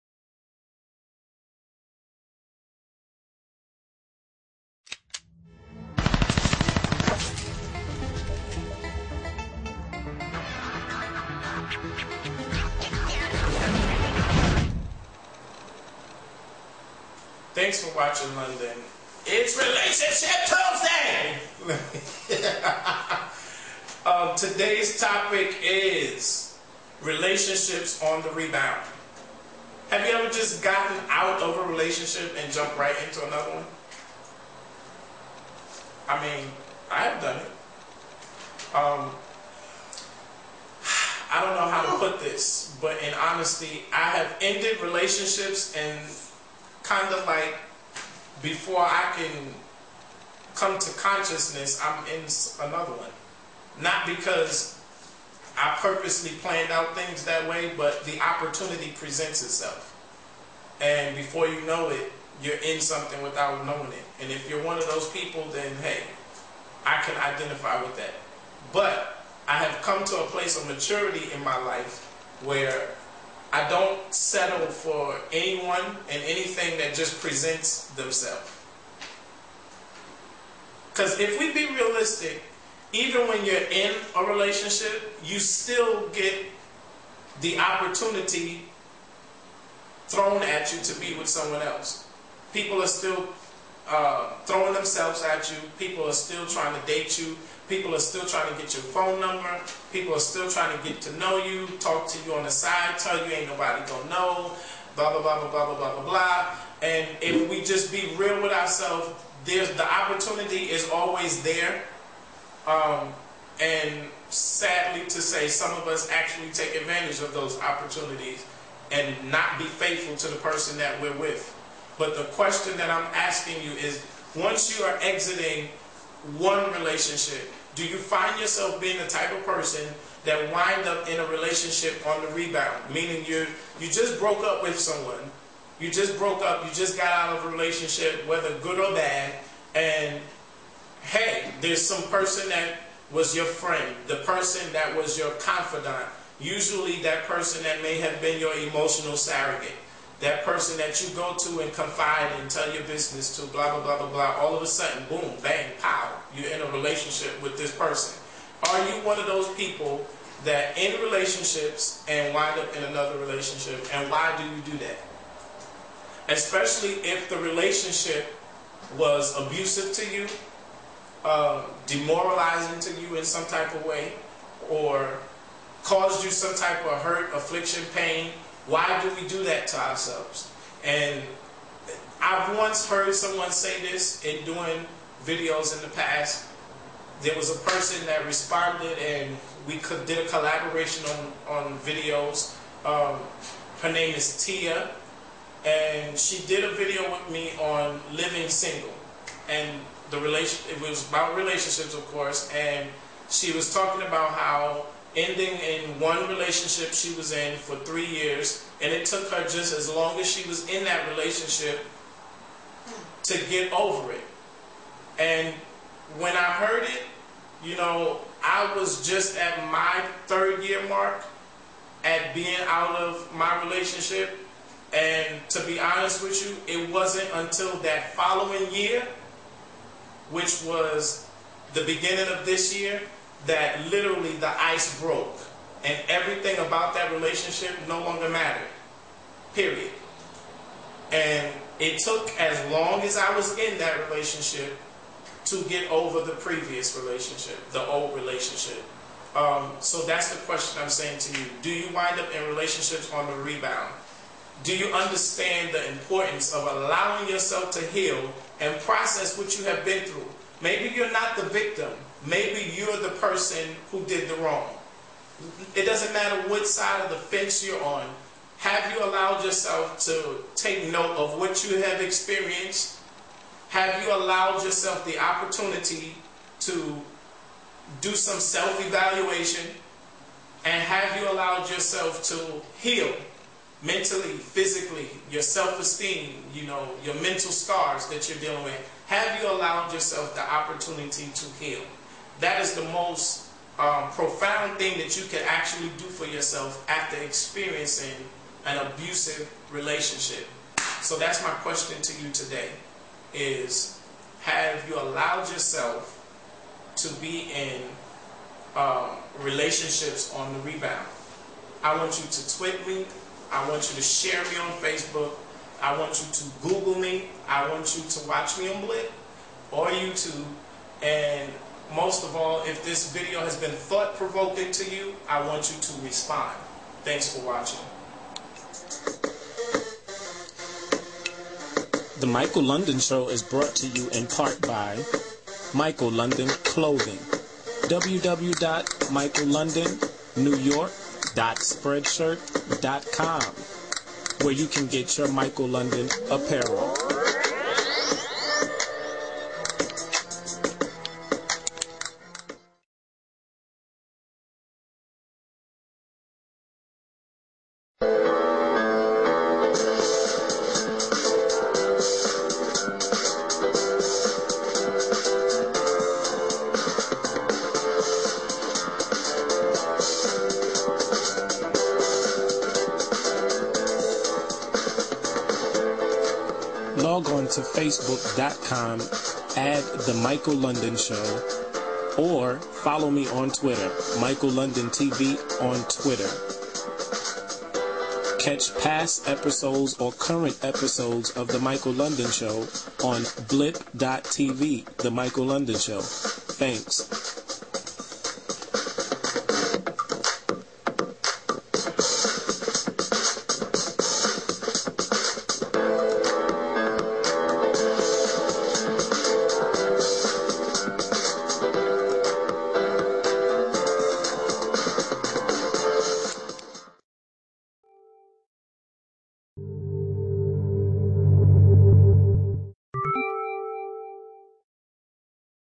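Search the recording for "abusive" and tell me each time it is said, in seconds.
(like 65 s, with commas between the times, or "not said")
169 s, 298 s.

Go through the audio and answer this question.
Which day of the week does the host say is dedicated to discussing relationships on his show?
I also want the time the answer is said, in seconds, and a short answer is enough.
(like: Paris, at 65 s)
Tuesday, at 19 s.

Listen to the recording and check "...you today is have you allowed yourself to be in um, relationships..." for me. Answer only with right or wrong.
right.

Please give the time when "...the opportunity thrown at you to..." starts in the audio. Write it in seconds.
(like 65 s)
87 s.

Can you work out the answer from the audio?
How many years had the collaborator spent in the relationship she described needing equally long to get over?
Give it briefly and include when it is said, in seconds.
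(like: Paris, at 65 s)
3, at 207 s.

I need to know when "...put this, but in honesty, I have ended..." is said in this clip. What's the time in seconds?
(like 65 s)
41 s.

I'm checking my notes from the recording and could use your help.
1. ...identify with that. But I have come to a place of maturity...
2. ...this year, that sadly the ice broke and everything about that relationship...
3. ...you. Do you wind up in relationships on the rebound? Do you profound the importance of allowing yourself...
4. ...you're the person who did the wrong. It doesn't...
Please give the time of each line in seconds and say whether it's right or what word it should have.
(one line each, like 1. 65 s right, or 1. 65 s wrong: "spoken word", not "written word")
1. 67 s right
2. 232 s wrong: "literally", not "sadly"
3. 251 s wrong: "understand", not "profound"
4. 262 s right.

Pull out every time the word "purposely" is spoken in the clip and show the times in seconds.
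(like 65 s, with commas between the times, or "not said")
55 s.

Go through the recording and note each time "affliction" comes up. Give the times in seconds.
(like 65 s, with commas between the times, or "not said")
177 s.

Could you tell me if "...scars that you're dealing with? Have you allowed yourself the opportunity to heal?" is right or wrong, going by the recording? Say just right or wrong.
right.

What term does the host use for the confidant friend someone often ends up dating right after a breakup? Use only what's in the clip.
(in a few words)
emotional surrogate.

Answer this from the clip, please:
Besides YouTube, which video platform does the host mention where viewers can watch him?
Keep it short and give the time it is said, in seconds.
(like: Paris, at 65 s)
Blip, at 318 s.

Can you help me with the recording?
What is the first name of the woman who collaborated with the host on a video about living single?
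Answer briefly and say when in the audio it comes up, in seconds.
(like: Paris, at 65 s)
Tia, at 194 s.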